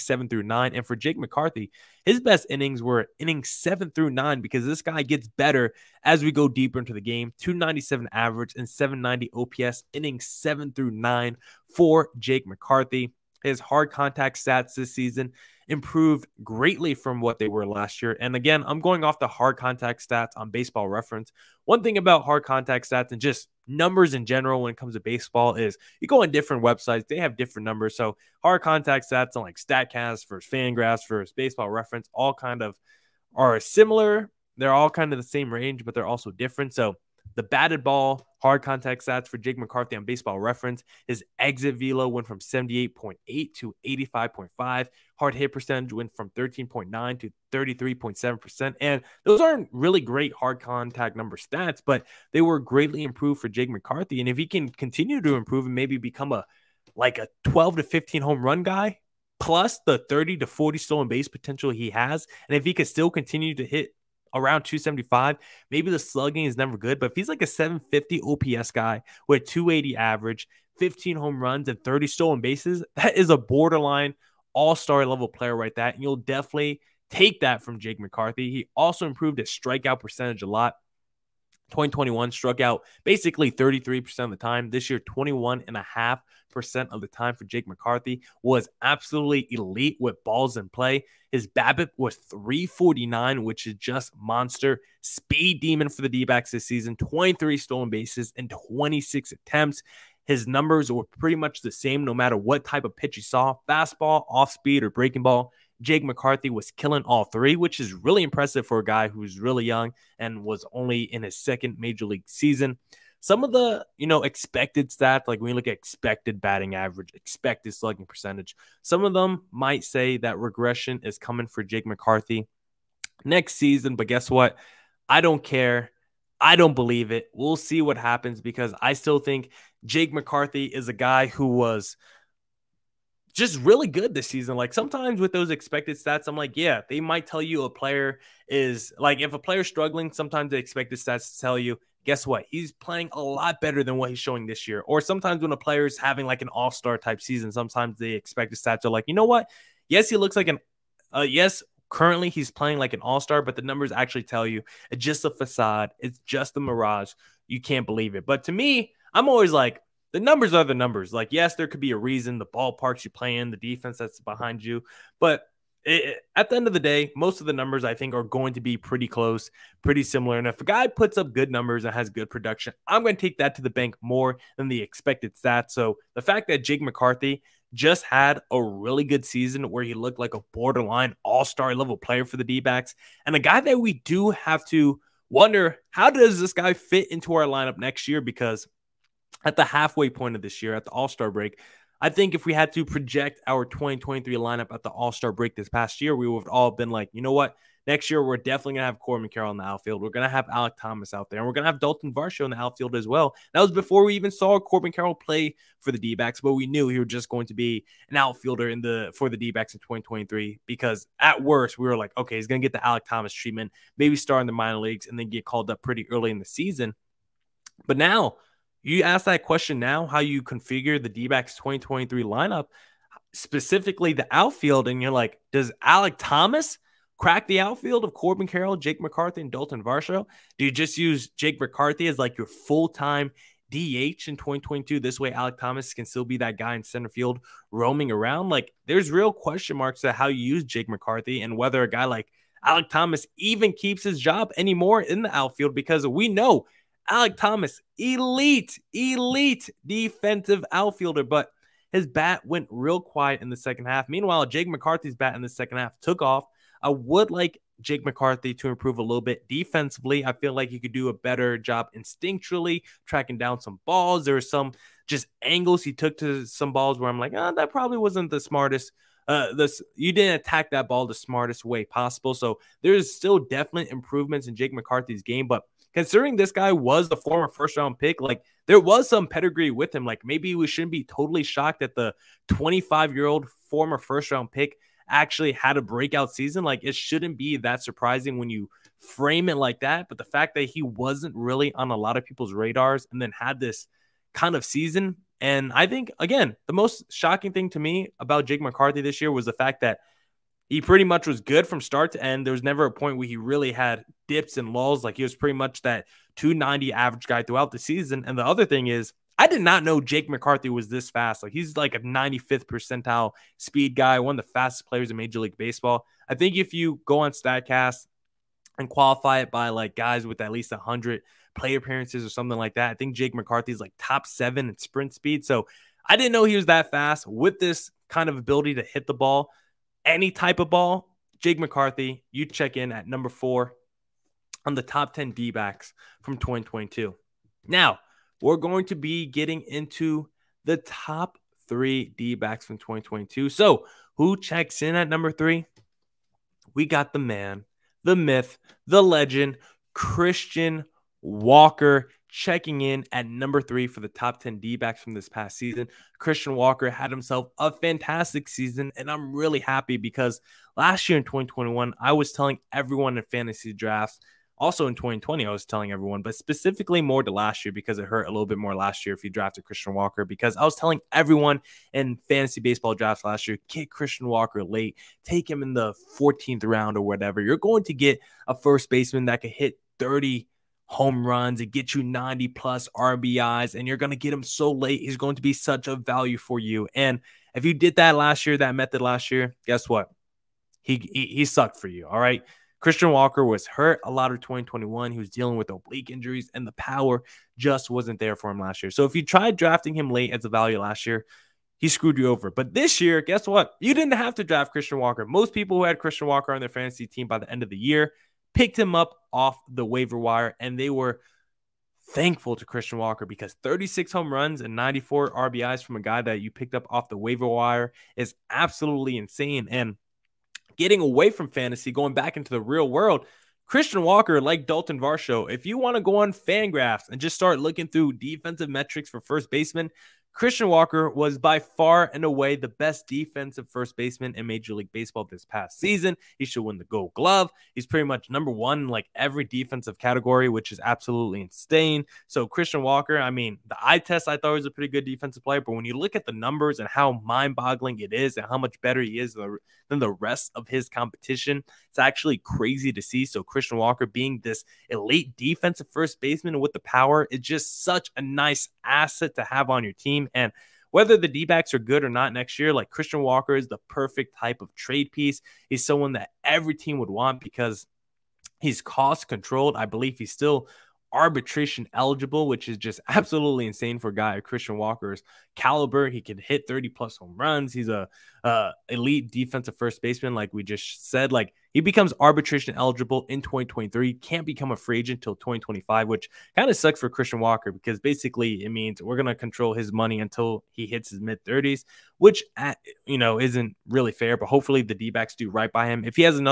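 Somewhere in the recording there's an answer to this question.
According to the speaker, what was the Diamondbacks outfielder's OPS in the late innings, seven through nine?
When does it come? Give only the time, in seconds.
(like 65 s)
8 s.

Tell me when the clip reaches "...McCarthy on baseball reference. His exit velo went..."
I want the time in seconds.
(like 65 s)
39 s.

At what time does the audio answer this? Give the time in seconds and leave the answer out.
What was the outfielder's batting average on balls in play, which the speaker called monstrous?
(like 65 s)
92 s.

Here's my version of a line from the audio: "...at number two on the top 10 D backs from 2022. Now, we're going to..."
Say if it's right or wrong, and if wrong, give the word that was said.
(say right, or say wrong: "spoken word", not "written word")
wrong: "four", not "two".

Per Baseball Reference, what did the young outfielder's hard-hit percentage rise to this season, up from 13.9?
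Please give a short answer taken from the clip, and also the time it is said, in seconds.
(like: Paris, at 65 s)
33.7%, at 47 s.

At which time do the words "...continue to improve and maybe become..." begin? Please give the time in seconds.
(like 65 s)
54 s.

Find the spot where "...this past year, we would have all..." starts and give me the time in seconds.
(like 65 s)
195 s.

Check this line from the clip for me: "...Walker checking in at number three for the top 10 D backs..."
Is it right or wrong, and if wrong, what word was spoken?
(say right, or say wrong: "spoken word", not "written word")
right.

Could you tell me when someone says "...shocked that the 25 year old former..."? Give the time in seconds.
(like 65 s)
281 s.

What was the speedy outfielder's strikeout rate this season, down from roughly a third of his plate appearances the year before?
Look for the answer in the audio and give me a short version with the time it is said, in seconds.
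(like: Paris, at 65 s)
21.5%, at 84 s.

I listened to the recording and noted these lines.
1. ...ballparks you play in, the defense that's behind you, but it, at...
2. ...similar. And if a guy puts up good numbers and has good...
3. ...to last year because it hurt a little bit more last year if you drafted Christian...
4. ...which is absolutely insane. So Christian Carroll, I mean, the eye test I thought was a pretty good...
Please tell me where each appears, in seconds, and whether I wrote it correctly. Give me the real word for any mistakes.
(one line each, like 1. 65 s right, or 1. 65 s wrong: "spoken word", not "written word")
1. 162 s right
2. 170 s right
3. 367 s right
4. 440 s wrong: "Walker", not "Carroll".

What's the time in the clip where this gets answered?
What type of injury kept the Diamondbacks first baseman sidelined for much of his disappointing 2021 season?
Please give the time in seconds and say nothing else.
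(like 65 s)
395 s.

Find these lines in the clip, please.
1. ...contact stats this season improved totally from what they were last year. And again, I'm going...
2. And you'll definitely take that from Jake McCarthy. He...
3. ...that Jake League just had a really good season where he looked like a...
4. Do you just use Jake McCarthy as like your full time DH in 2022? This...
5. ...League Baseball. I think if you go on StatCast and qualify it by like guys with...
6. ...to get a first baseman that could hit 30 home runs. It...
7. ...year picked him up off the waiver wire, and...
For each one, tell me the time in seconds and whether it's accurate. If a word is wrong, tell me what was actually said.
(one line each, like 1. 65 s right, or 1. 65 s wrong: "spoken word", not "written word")
1. 13 s wrong: "greatly", not "totally"
2. 75 s right
3. 176 s wrong: "McCarthy", not "League"
4. 230 s right
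5. 315 s right
6. 377 s right
7. 407 s right.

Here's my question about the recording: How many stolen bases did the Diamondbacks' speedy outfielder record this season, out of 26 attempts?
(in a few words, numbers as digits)
23.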